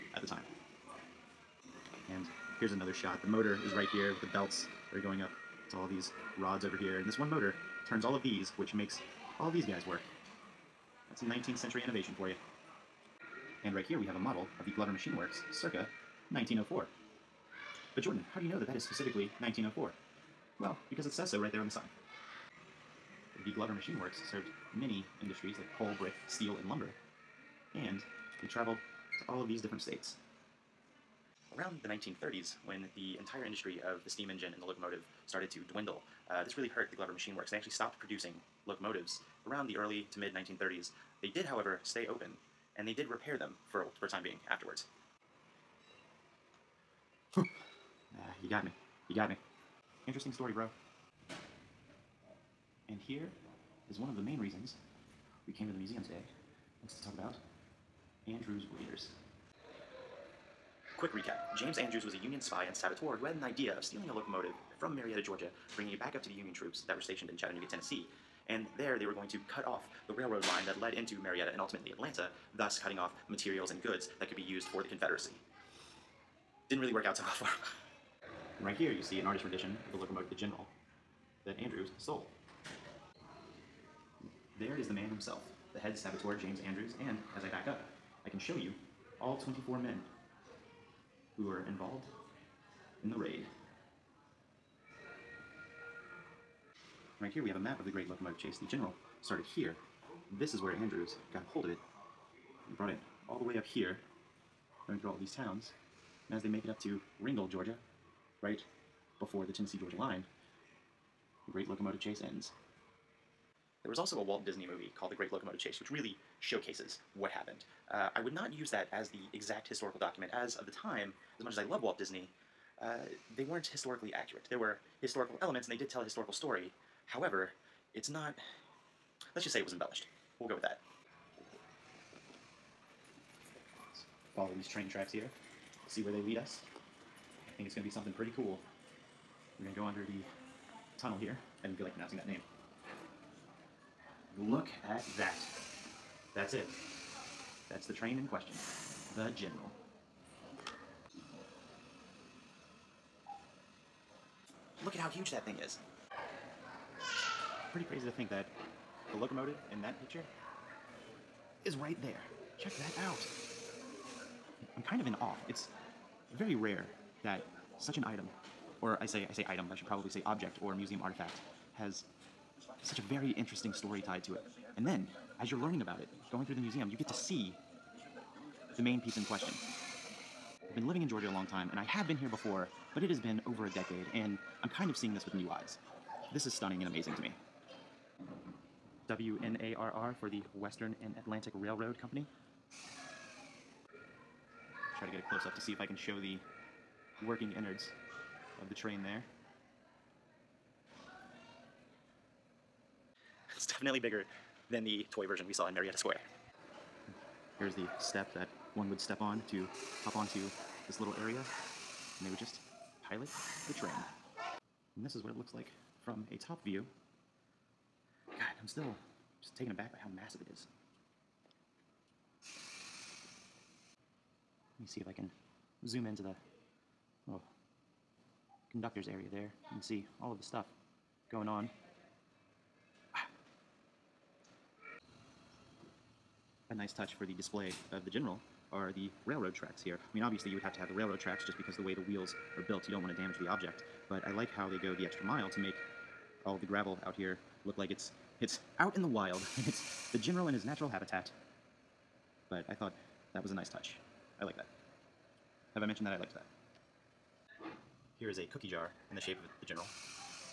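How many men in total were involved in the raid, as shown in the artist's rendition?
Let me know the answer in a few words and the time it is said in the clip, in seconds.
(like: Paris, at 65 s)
24, at 89 s.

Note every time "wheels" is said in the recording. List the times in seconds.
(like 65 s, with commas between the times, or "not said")
242 s.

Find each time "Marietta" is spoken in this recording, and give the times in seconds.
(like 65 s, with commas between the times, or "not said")
64 s, 71 s, 205 s.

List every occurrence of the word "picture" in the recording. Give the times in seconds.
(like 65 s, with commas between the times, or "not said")
160 s.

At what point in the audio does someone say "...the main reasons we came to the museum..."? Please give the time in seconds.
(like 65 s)
54 s.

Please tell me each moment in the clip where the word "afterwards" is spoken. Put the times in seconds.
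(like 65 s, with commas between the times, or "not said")
44 s.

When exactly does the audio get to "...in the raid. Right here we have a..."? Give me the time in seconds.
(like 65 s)
93 s.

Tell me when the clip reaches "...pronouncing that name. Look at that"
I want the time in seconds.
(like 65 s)
141 s.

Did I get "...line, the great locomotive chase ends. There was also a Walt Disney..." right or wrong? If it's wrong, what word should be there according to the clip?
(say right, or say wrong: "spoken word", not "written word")
right.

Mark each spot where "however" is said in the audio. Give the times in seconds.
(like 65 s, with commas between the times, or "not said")
41 s, 127 s.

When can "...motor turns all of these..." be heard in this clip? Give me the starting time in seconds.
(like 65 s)
7 s.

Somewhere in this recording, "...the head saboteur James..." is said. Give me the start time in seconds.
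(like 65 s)
85 s.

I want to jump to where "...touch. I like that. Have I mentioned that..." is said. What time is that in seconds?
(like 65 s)
253 s.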